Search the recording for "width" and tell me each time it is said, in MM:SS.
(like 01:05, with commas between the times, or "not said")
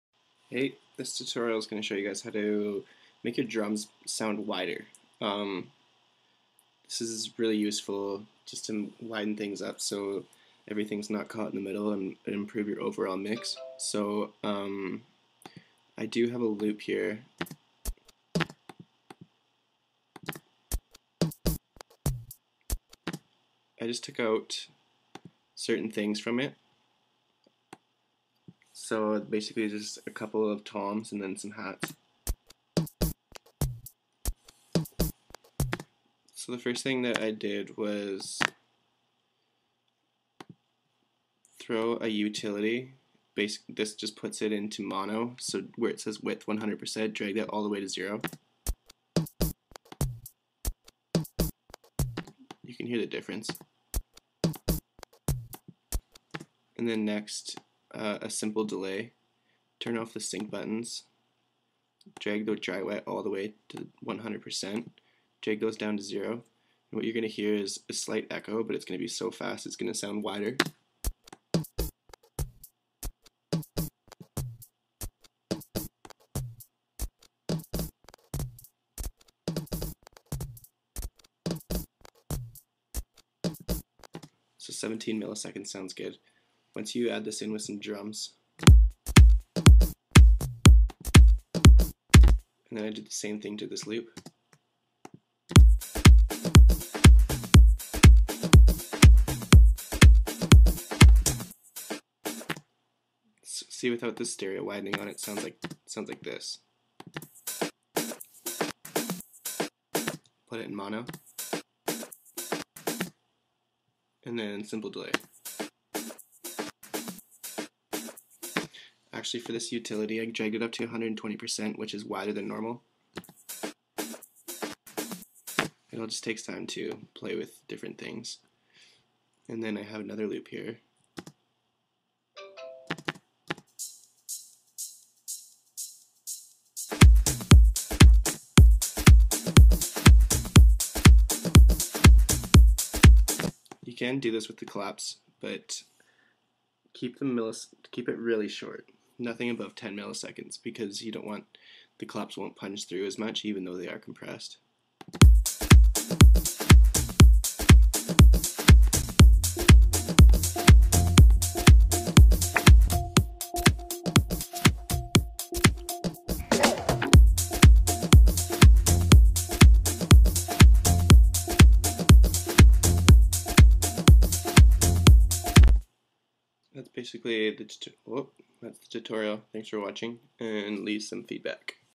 00:46.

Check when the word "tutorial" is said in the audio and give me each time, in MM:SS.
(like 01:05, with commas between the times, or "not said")
00:01, 02:58.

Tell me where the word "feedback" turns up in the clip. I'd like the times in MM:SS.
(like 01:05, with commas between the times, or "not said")
03:01.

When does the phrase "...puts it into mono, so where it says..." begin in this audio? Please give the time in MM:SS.
00:44.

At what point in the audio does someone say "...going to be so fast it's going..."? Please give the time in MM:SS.
01:08.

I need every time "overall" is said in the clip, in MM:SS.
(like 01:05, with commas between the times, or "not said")
00:12.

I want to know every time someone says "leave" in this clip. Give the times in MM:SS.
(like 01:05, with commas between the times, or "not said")
03:00.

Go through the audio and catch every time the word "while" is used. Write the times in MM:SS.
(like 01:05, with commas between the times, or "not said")
not said.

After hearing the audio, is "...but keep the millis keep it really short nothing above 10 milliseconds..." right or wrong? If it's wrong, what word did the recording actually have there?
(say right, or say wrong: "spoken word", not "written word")
right.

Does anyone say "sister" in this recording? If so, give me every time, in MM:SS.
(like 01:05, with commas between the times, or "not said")
not said.